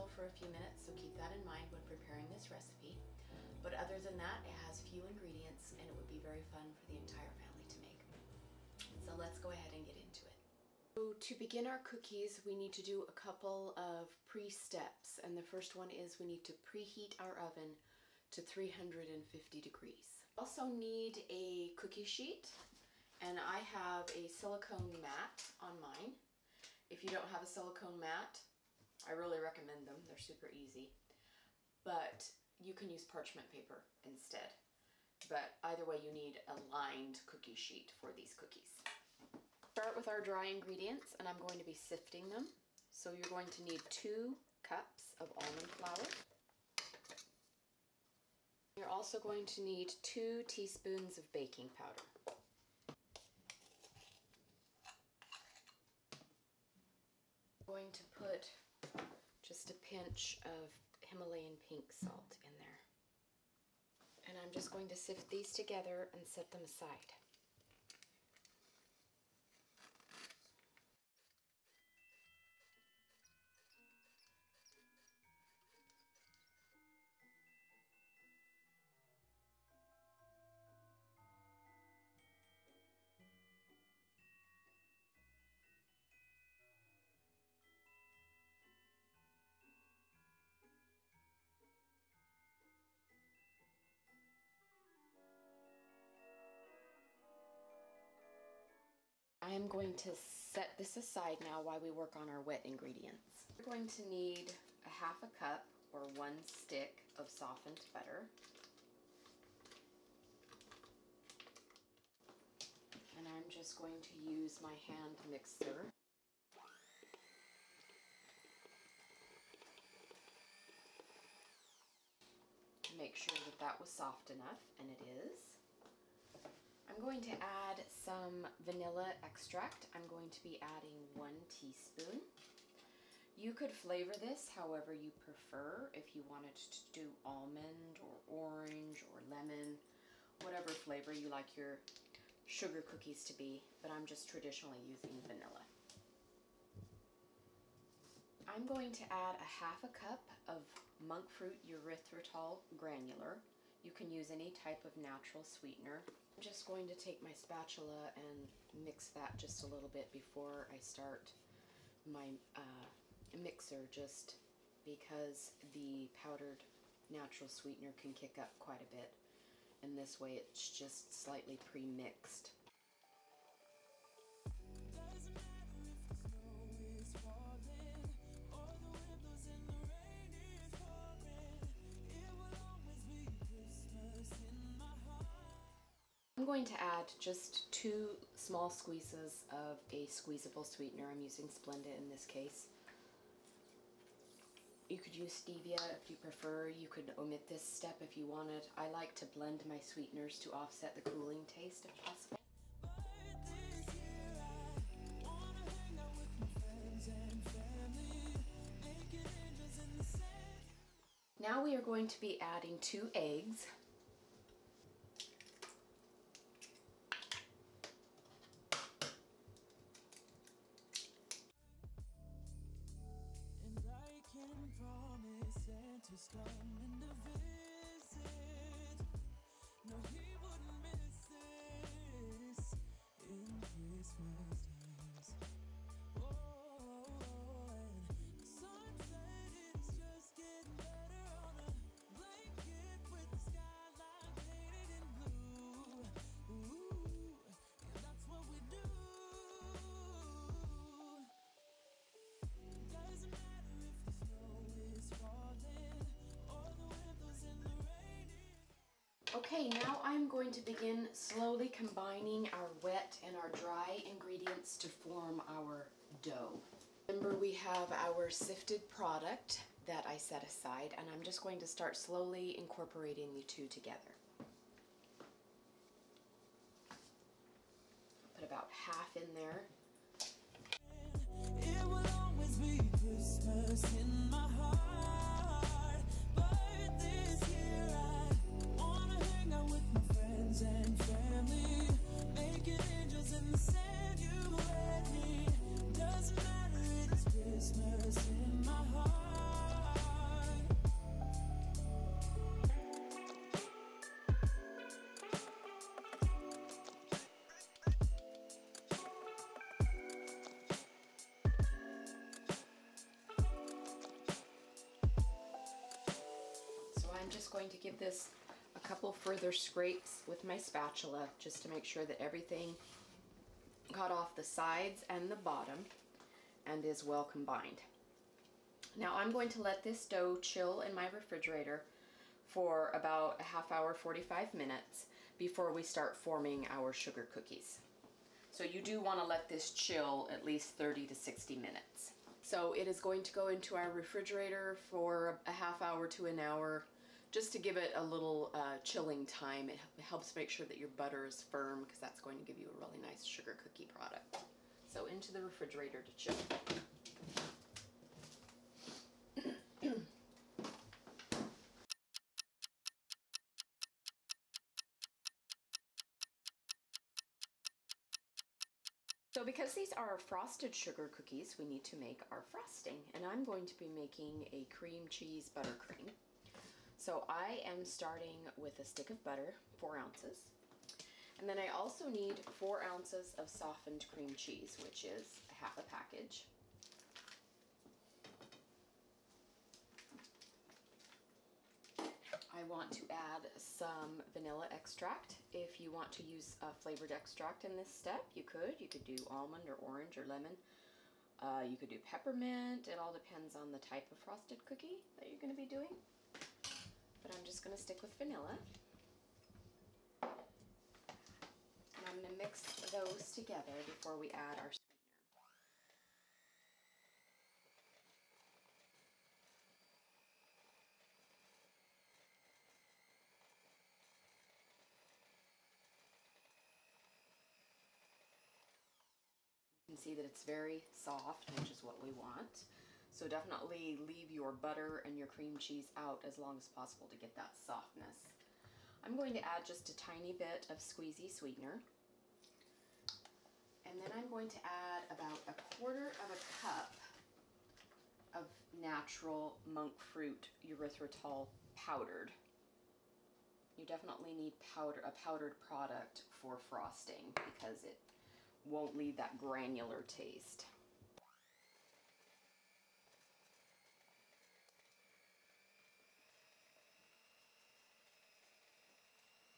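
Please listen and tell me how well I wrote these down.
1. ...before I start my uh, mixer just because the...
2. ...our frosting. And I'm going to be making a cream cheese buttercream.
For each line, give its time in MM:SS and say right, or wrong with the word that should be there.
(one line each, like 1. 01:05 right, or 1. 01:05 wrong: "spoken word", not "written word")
1. 02:40 right
2. 06:12 right.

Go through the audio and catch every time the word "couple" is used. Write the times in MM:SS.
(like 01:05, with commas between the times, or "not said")
00:13, 05:18.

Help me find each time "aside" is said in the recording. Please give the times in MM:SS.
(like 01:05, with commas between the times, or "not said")
01:06, 01:40, 04:30.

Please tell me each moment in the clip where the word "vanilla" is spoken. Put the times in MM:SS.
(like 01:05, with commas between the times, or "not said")
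02:08, 02:25, 06:34, 06:48.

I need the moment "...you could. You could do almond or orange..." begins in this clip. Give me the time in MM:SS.
06:38.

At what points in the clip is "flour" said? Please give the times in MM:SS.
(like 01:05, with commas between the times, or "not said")
00:45.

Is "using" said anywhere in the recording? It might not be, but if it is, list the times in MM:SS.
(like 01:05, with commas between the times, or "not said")
02:24, 03:11.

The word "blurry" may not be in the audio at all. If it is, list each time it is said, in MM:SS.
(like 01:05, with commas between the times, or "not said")
not said.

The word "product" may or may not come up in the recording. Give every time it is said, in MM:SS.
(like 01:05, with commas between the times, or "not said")
04:28, 05:53, 07:35.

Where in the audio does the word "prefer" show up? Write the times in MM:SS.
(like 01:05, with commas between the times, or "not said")
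02:15, 03:16.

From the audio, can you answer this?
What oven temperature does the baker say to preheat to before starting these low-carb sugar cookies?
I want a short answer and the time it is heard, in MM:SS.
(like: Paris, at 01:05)
350 degrees, at 00:18.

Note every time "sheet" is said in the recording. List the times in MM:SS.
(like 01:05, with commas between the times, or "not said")
00:22, 00:37.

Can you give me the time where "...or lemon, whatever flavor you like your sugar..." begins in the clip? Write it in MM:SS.
02:19.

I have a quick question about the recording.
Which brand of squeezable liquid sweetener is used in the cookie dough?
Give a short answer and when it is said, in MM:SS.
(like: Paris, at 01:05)
Splenda, at 03:11.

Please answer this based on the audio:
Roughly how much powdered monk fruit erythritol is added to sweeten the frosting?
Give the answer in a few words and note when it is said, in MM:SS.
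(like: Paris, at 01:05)
a quarter of a cup, at 07:25.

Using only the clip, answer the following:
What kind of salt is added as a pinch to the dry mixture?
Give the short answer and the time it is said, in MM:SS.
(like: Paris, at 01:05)
Himalayan pink salt, at 01:01.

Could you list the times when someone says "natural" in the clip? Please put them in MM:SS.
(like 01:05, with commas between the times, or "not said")
02:34, 02:47, 07:28.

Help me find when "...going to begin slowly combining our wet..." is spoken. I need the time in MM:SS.
04:20.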